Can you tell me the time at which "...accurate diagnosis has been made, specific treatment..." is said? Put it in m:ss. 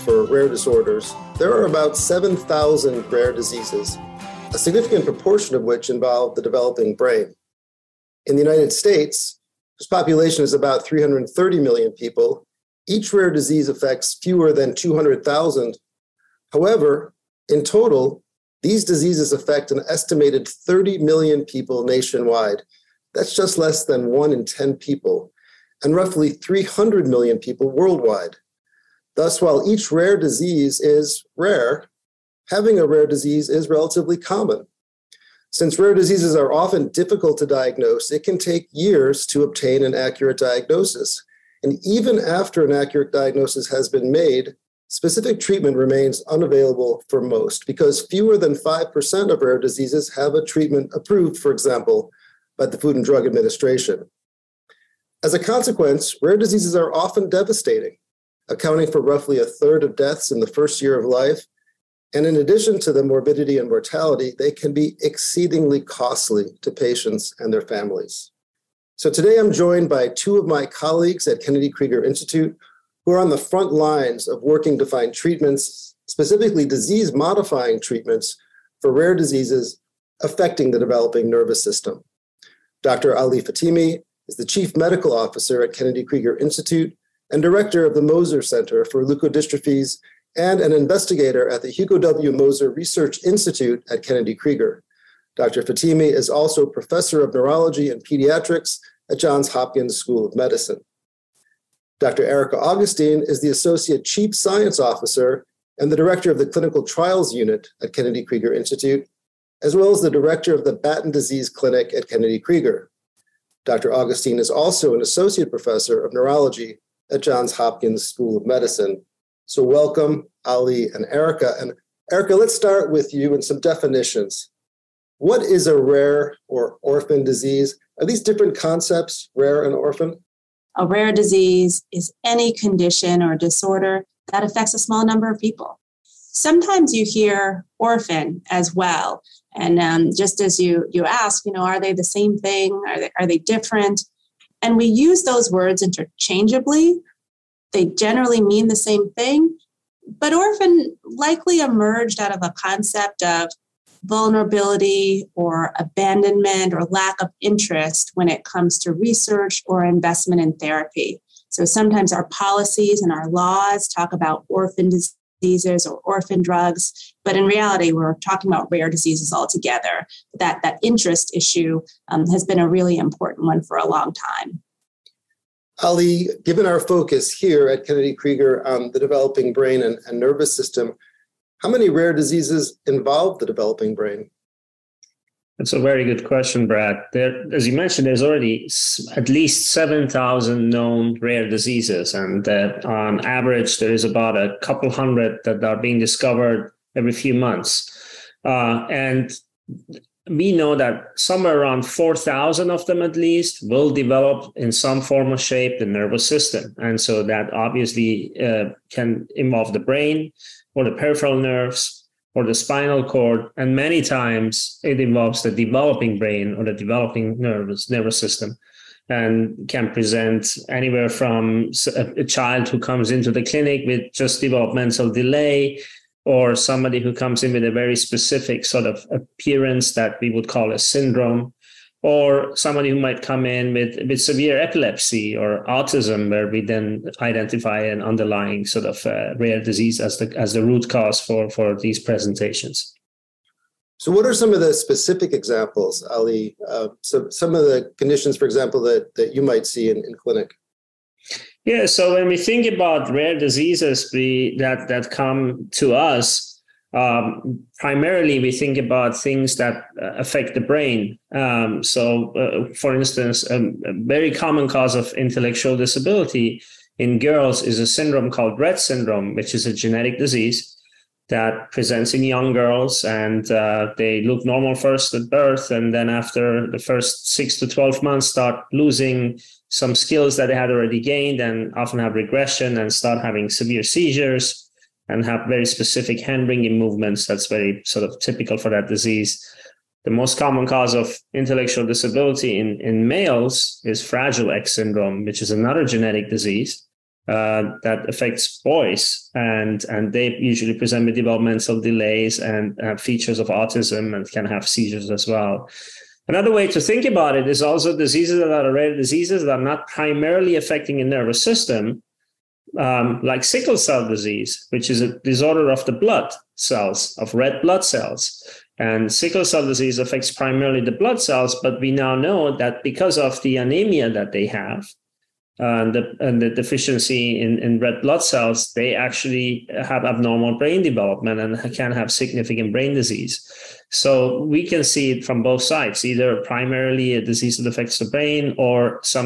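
0:42.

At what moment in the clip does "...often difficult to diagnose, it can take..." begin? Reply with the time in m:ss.
0:36.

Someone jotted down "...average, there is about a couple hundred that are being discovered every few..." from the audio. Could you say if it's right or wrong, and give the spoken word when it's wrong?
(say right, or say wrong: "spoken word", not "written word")
right.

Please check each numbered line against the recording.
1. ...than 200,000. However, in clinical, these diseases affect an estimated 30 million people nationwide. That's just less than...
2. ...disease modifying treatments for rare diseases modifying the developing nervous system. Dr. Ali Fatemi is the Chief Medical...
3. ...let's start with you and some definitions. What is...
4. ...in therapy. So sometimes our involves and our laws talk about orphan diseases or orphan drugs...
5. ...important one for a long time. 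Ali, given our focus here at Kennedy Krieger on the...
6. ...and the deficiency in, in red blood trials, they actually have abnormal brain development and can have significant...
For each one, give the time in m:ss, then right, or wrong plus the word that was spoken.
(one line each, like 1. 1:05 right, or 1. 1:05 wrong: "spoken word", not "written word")
1. 0:14 wrong: "total", not "clinical"
2. 1:16 wrong: "affecting", not "modifying"
3. 2:02 right
4. 2:40 wrong: "policies", not "involves"
5. 2:52 right
6. 5:26 wrong: "cells", not "trials".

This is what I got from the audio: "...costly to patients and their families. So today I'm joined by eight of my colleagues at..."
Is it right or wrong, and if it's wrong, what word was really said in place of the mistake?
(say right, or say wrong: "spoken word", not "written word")
wrong: "two", not "eight".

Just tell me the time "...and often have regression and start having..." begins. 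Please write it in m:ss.
4:41.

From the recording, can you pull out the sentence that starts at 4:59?
And, and they usually present with developmental delays and uh, features of autism and can have seizures as well.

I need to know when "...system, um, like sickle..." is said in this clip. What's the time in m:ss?
5:11.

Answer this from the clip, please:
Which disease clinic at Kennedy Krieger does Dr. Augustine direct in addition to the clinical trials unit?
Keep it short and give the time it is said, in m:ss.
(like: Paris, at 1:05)
Batten Disease Clinic, at 1:50.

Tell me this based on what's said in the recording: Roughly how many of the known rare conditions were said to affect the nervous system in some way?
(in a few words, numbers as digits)
4,000.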